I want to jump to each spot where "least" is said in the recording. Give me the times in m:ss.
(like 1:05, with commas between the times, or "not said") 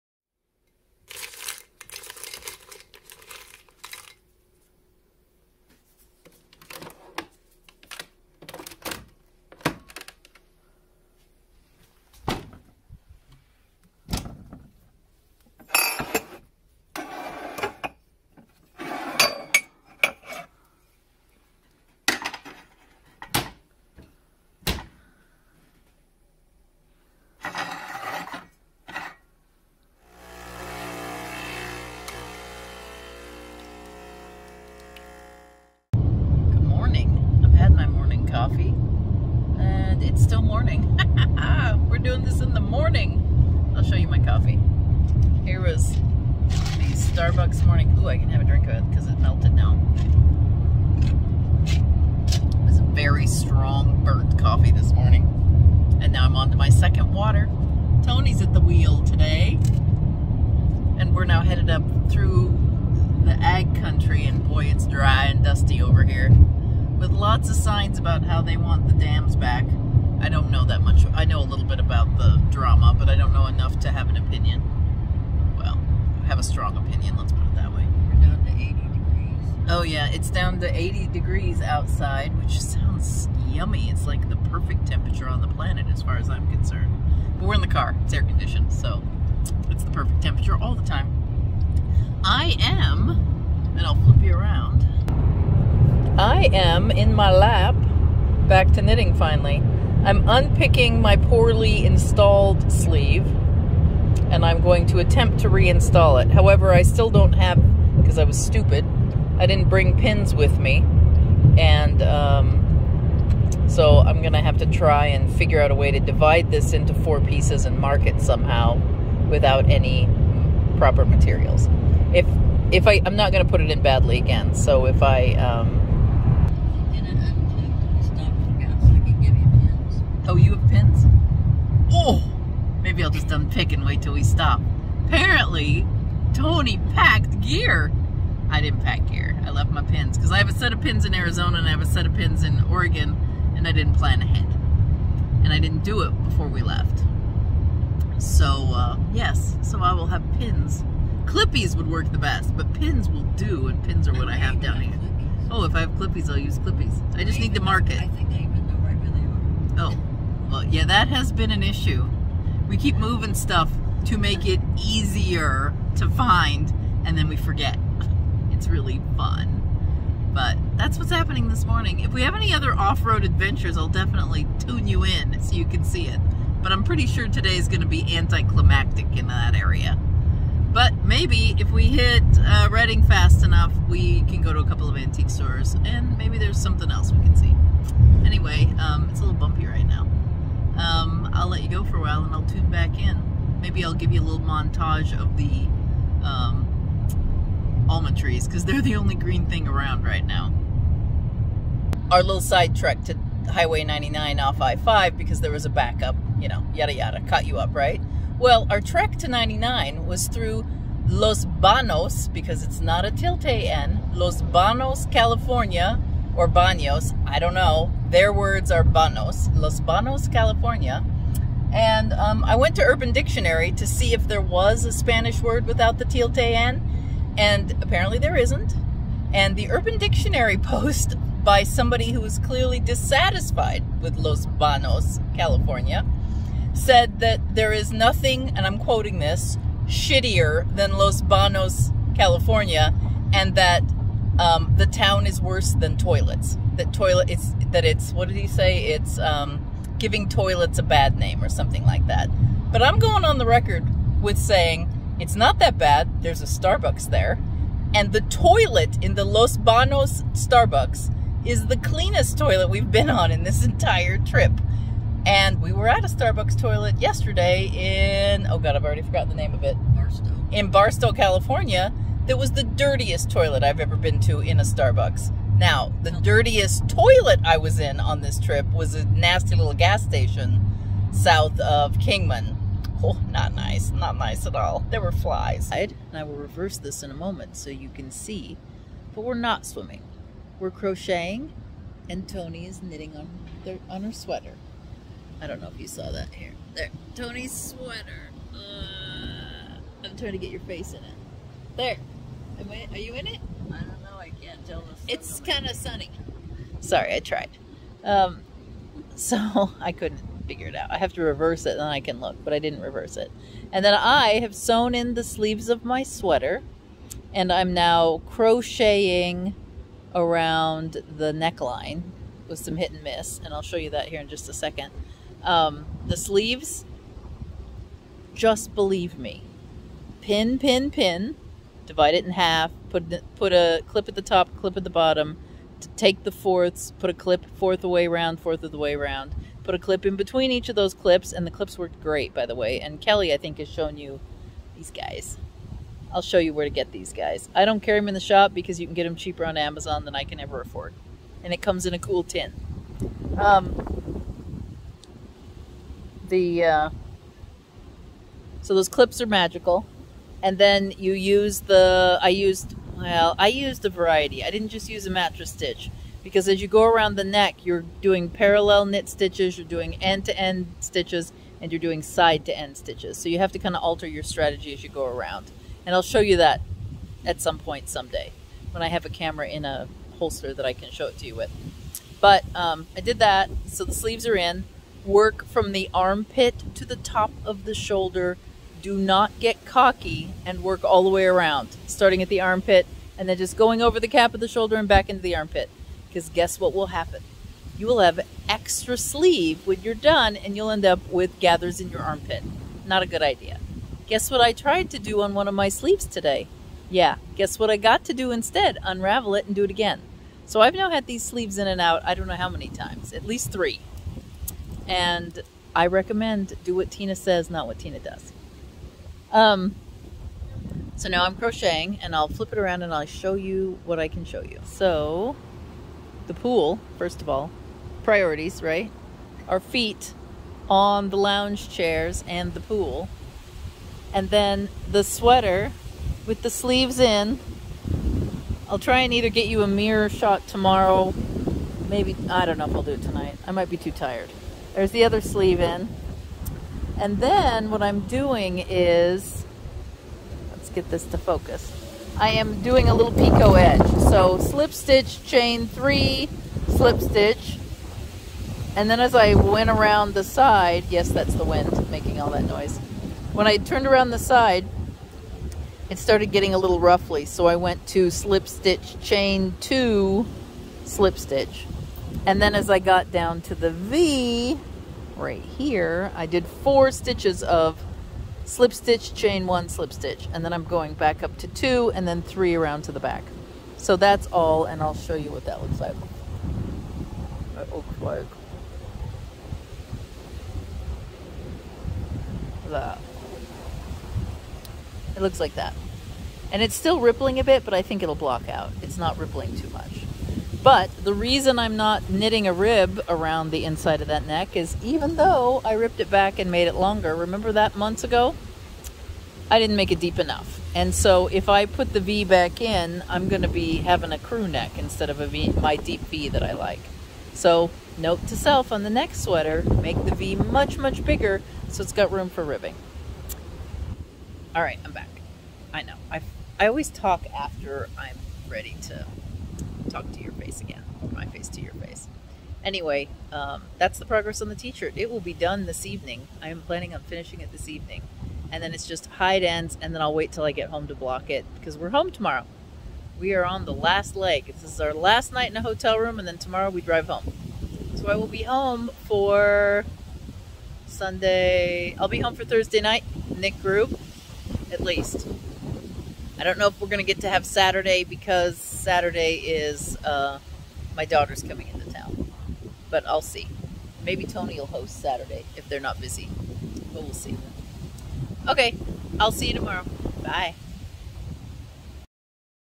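6:53, 9:14.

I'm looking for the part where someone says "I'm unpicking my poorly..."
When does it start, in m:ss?
1:40.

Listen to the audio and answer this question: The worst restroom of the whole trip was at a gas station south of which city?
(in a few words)
Kingman.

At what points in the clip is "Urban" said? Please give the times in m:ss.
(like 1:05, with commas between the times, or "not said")
3:42, 3:49.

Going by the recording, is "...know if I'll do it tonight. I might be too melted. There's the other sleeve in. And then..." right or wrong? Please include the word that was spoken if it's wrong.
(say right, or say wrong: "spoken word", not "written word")
wrong: "tired", not "melted".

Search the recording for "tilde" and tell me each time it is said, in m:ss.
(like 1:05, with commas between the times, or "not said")
3:33, 3:46.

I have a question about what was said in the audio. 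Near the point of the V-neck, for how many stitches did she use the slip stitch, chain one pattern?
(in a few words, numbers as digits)
4.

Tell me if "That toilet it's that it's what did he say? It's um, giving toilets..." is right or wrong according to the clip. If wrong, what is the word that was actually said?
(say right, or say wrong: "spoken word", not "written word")
right.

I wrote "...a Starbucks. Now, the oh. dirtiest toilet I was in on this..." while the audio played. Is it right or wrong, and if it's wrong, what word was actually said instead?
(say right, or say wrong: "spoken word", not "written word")
right.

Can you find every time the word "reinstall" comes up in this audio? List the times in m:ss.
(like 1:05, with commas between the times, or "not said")
1:45.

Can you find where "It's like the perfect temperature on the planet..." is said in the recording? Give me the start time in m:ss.
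1:23.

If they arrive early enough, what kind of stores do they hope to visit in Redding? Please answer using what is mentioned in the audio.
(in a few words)
antique stores.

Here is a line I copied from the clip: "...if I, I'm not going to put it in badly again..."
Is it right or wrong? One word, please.
right.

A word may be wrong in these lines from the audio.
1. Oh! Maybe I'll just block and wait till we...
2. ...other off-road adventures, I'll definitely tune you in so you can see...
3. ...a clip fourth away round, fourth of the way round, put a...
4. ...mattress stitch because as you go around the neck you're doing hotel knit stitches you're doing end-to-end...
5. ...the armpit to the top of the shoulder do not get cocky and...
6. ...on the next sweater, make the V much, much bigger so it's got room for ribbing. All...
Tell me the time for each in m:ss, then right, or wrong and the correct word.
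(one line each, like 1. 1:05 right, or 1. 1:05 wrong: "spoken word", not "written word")
1. 2:11 wrong: "unpick", not "block"
2. 2:52 right
3. 5:37 right
4. 6:05 wrong: "parallel", not "hotel"
5. 6:25 right
6. 8:38 right.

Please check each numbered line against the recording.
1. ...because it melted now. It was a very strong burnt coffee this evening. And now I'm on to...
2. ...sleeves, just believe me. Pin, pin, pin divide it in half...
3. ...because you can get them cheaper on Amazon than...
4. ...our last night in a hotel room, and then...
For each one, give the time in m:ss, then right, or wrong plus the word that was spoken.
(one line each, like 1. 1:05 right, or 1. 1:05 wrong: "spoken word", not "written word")
1. 0:48 wrong: "morning", not "evening"
2. 5:26 right
3. 5:48 right
4. 9:04 right.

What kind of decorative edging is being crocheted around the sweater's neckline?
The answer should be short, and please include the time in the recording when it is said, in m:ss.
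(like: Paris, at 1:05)
picot edge, at 7:33.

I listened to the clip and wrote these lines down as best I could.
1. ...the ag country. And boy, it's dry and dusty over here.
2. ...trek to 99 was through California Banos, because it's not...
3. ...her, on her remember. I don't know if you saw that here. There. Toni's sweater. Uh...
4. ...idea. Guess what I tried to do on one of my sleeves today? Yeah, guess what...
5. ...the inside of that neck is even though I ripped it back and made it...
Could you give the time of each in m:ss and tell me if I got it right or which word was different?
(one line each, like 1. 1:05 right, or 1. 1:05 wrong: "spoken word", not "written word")
1. 1:03 right
2. 3:28 wrong: "Los", not "California"
3. 4:53 wrong: "sweater", not "remember"
4. 6:43 right
5. 8:23 right.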